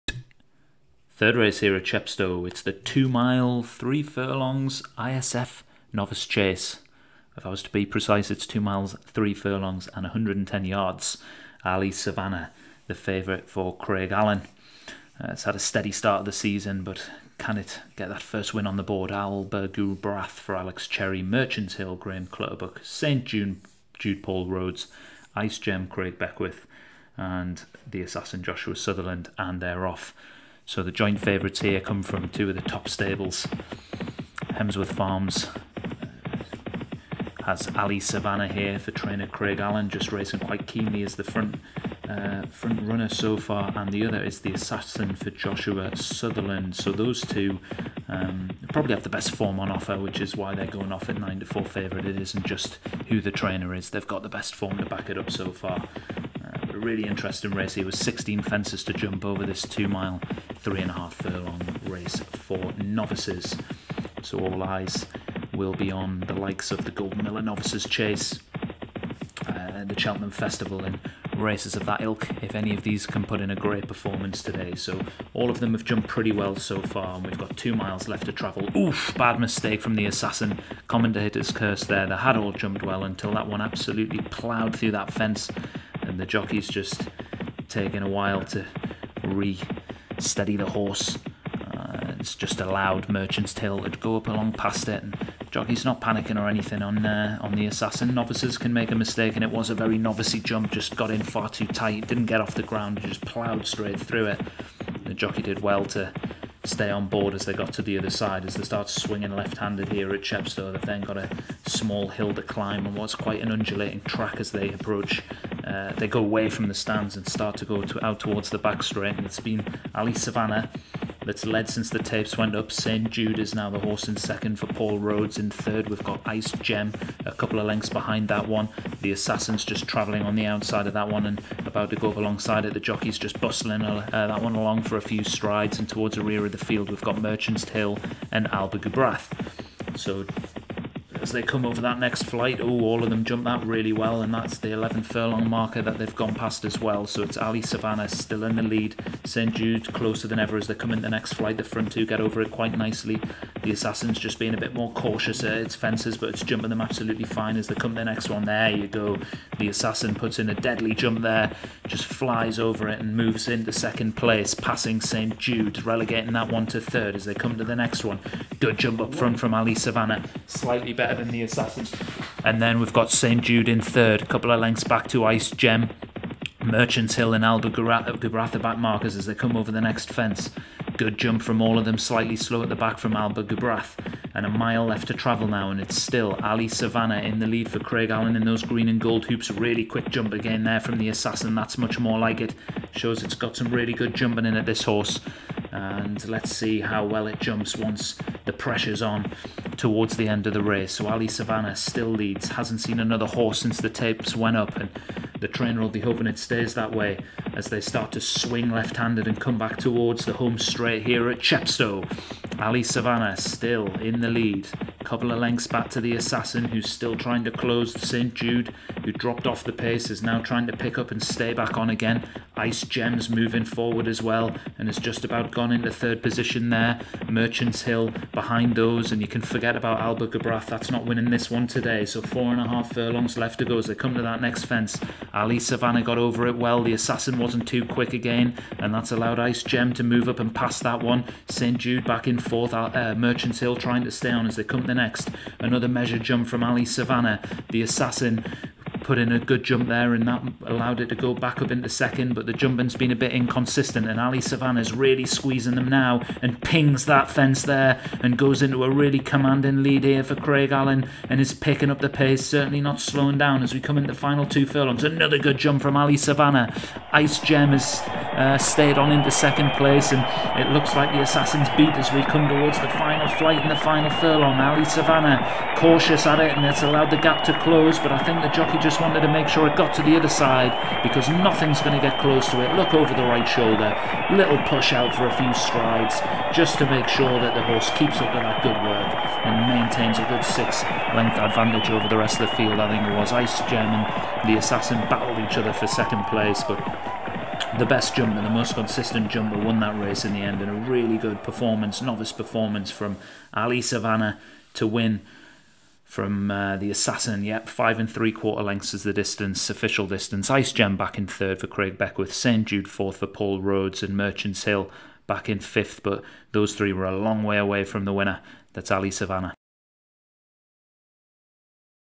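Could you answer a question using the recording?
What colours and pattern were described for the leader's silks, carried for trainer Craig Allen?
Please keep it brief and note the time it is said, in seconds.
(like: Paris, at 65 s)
Green and gold hoops, at 188 s.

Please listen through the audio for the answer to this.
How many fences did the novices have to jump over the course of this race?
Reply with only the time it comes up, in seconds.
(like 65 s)
57 s.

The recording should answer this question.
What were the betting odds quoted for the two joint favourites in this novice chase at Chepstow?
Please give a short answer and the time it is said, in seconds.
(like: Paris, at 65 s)
9/4, at 51 s.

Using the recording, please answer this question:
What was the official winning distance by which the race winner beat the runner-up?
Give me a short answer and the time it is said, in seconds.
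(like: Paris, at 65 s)
5 3/4 lengths, at 307 s.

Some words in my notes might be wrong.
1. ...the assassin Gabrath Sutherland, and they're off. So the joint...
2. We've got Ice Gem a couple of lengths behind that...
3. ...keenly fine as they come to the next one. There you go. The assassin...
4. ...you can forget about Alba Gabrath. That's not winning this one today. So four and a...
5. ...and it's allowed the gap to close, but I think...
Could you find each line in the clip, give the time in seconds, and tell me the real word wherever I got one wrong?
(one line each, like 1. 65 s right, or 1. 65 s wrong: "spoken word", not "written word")
1. 27 s wrong: "Joshua", not "Gabrath"
2. 125 s right
3. 156 s wrong: "absolutely", not "keenly"
4. 229 s right
5. 276 s right.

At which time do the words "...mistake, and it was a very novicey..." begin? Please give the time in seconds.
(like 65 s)
98 s.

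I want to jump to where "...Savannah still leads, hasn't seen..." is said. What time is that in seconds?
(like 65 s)
201 s.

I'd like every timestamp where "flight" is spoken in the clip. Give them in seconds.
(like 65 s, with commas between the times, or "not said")
142 s, 151 s, 273 s.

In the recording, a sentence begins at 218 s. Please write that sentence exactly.
Jude, who dropped off the pace, is now trying to pick up and stay back on again.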